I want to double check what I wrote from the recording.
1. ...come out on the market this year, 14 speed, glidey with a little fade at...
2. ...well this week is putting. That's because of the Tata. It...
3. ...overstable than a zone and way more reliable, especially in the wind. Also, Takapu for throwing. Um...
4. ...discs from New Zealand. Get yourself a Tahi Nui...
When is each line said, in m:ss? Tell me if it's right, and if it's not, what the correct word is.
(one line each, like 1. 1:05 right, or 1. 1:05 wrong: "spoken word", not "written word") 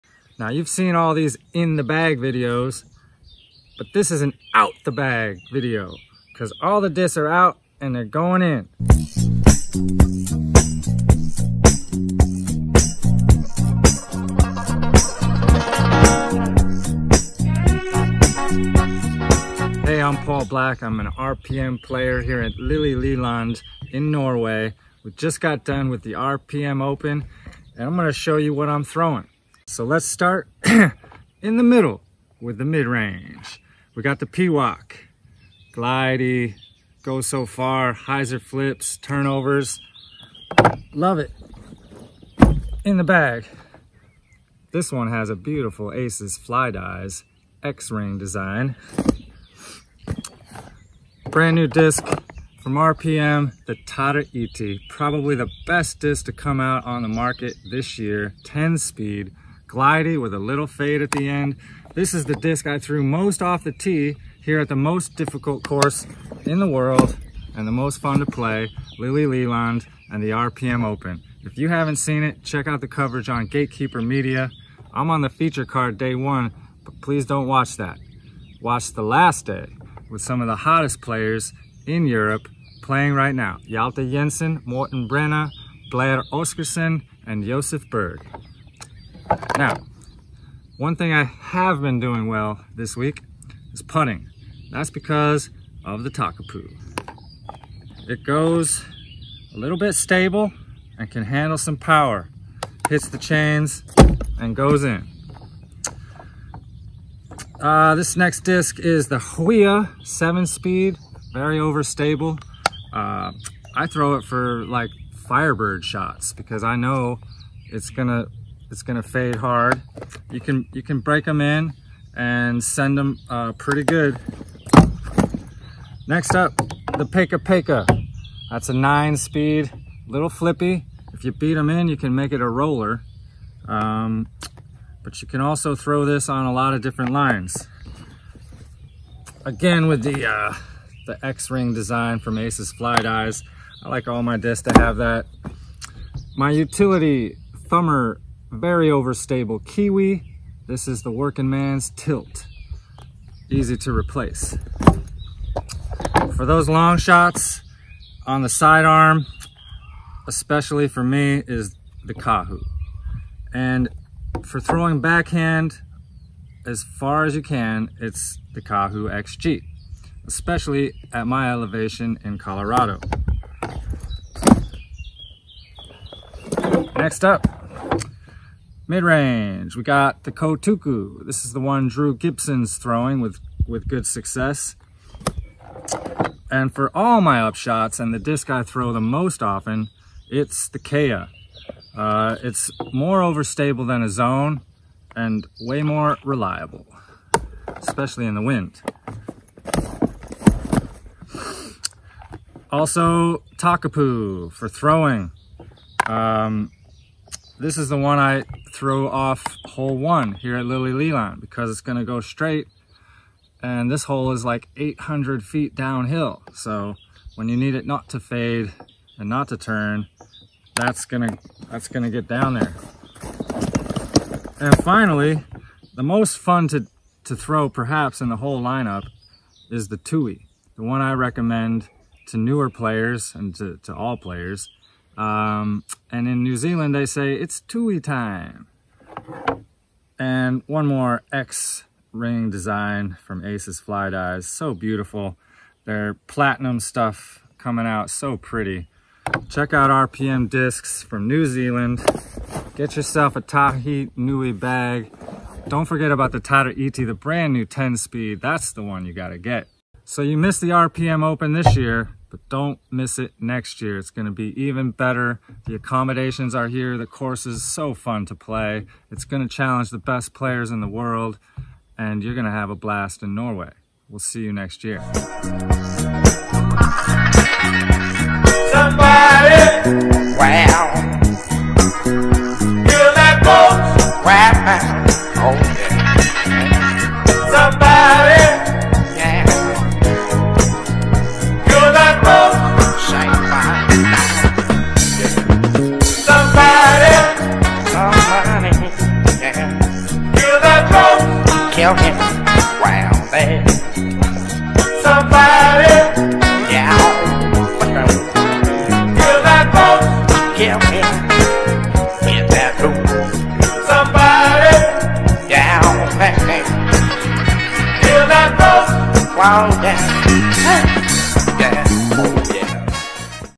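1. 0:56 wrong: "10", not "14"
2. 1:32 wrong: "Takapu", not "Tata"
3. 3:13 right
4. 4:10 right.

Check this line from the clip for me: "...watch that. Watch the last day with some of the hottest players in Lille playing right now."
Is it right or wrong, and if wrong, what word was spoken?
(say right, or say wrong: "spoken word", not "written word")
wrong: "Europe", not "Lille".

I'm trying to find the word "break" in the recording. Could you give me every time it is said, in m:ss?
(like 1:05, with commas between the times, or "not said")
2:01.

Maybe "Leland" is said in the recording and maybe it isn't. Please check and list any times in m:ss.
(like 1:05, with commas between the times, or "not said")
0:22, 1:09, 3:30.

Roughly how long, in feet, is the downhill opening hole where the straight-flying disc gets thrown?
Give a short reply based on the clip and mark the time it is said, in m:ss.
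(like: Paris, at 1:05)
800 feet, at 3:34.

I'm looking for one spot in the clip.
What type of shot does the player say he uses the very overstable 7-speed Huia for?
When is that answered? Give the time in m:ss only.
1:55.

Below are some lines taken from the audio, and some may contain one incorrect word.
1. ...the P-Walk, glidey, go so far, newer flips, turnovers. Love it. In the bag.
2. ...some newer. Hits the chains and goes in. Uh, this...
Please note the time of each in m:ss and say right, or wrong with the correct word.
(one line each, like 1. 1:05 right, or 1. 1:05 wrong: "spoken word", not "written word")
1. 0:34 wrong: "hyzer", not "newer"
2. 1:41 wrong: "power", not "newer".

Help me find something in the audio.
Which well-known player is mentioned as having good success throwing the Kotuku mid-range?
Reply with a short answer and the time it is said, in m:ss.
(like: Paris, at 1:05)
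Drew Gibson, at 3:01.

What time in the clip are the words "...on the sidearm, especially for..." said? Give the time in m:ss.
2:38.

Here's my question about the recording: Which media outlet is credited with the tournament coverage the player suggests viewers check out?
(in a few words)
Gatekeeper Media.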